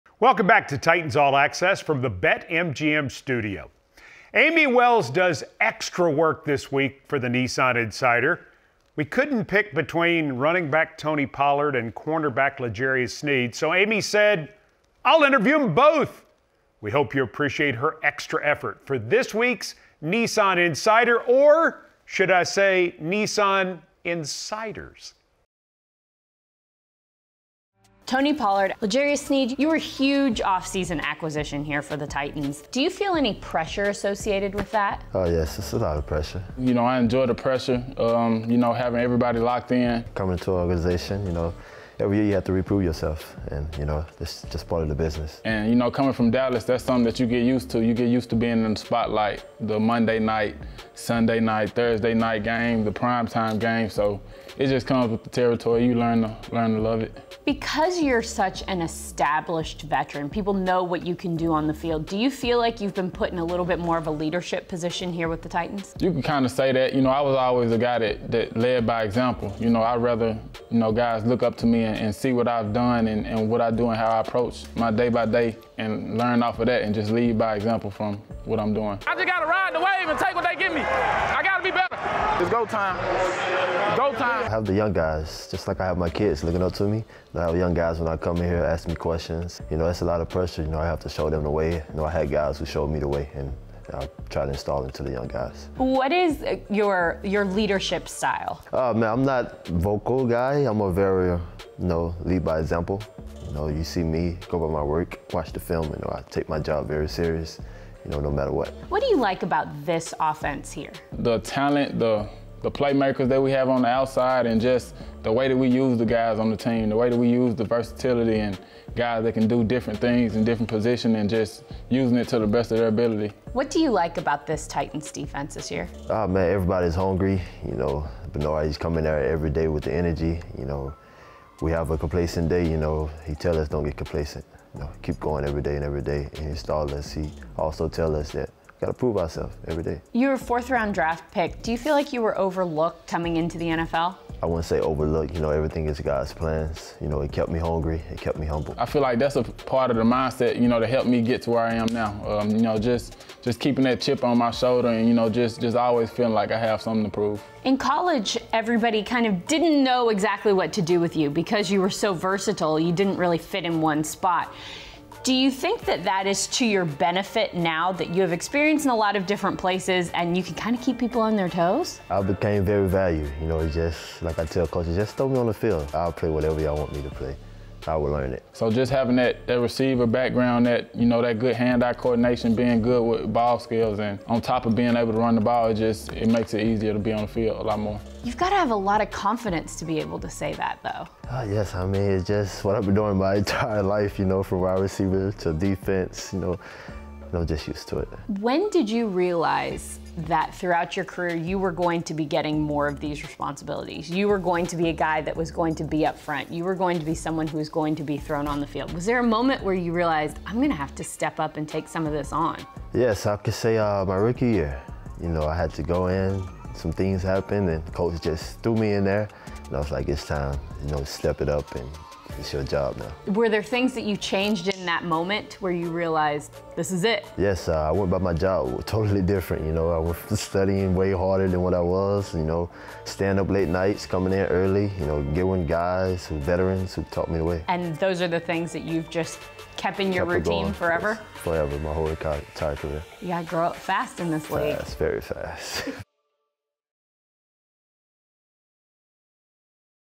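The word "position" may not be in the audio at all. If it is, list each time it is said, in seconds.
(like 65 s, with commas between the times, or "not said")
64 s, 120 s.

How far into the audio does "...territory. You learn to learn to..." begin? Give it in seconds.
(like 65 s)
55 s.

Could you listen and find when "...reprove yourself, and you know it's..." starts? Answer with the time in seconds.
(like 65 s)
42 s.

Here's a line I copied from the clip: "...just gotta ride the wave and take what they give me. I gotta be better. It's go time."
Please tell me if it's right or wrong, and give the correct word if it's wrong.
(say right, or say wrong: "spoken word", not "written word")
right.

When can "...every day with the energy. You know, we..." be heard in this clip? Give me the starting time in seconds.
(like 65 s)
129 s.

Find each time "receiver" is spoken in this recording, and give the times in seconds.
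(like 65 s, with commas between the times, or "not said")
179 s, 194 s.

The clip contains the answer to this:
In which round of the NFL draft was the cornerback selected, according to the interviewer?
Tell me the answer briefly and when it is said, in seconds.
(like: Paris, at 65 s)
Fourth round, at 140 s.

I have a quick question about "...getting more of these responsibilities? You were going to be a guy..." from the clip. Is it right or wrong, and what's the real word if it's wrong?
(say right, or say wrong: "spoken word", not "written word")
right.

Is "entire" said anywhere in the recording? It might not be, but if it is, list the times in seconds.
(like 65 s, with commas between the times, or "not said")
193 s, 242 s.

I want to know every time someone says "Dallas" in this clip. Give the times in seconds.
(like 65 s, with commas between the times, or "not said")
46 s.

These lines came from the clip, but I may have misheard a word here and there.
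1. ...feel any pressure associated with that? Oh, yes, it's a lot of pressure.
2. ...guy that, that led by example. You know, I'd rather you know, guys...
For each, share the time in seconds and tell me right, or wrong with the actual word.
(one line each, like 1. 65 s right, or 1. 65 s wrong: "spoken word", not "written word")
1. 32 s right
2. 67 s right.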